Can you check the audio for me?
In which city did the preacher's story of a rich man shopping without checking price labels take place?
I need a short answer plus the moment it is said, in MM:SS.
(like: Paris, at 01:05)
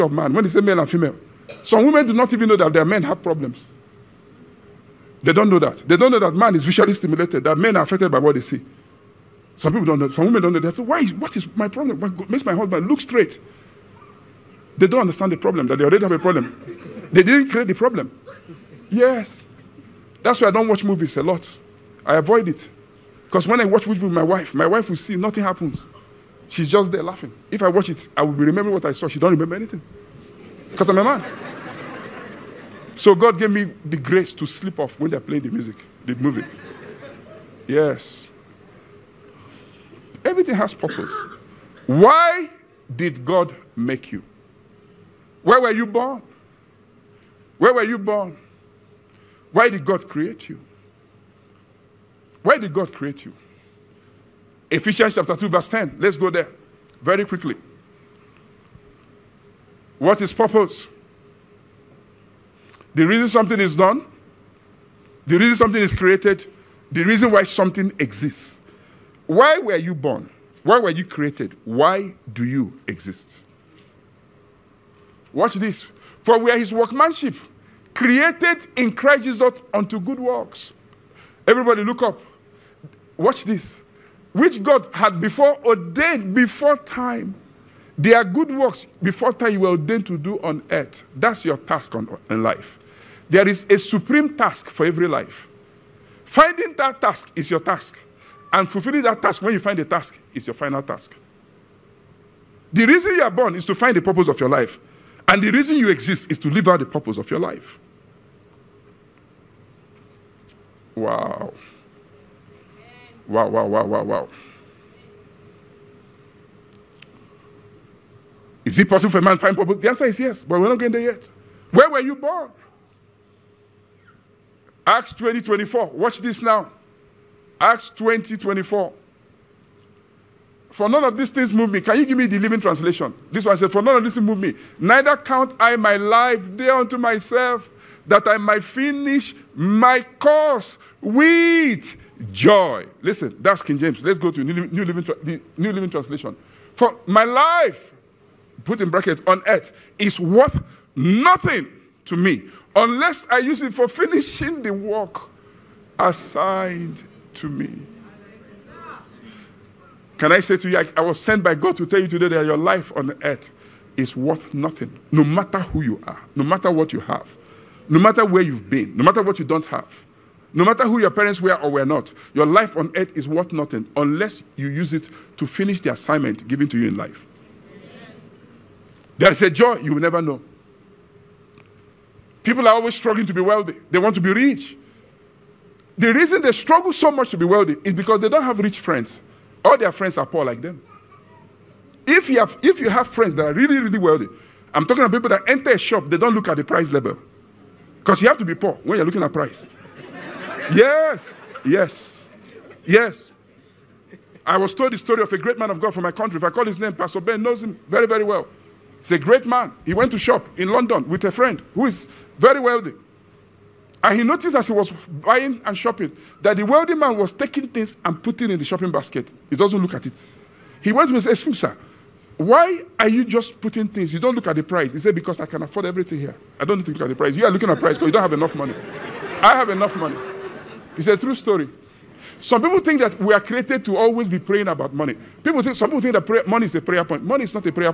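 London, at 03:30.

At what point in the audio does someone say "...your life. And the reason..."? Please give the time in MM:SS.
01:44.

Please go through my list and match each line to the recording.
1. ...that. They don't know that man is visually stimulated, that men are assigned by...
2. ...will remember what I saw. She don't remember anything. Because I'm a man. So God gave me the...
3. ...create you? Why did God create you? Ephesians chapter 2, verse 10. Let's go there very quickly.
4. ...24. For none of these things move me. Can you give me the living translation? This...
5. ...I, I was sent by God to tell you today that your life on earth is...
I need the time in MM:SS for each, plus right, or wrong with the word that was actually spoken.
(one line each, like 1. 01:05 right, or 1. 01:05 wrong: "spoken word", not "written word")
1. 00:05 wrong: "affected", not "assigned"
2. 00:28 right
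3. 00:50 right
4. 02:08 right
5. 02:40 right.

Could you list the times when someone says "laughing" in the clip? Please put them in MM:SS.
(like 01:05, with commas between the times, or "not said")
00:27.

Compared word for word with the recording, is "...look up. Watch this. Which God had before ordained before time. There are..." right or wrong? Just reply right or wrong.
right.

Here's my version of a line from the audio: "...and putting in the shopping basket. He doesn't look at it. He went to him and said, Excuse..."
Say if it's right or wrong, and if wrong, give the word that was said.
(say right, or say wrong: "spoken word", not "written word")
right.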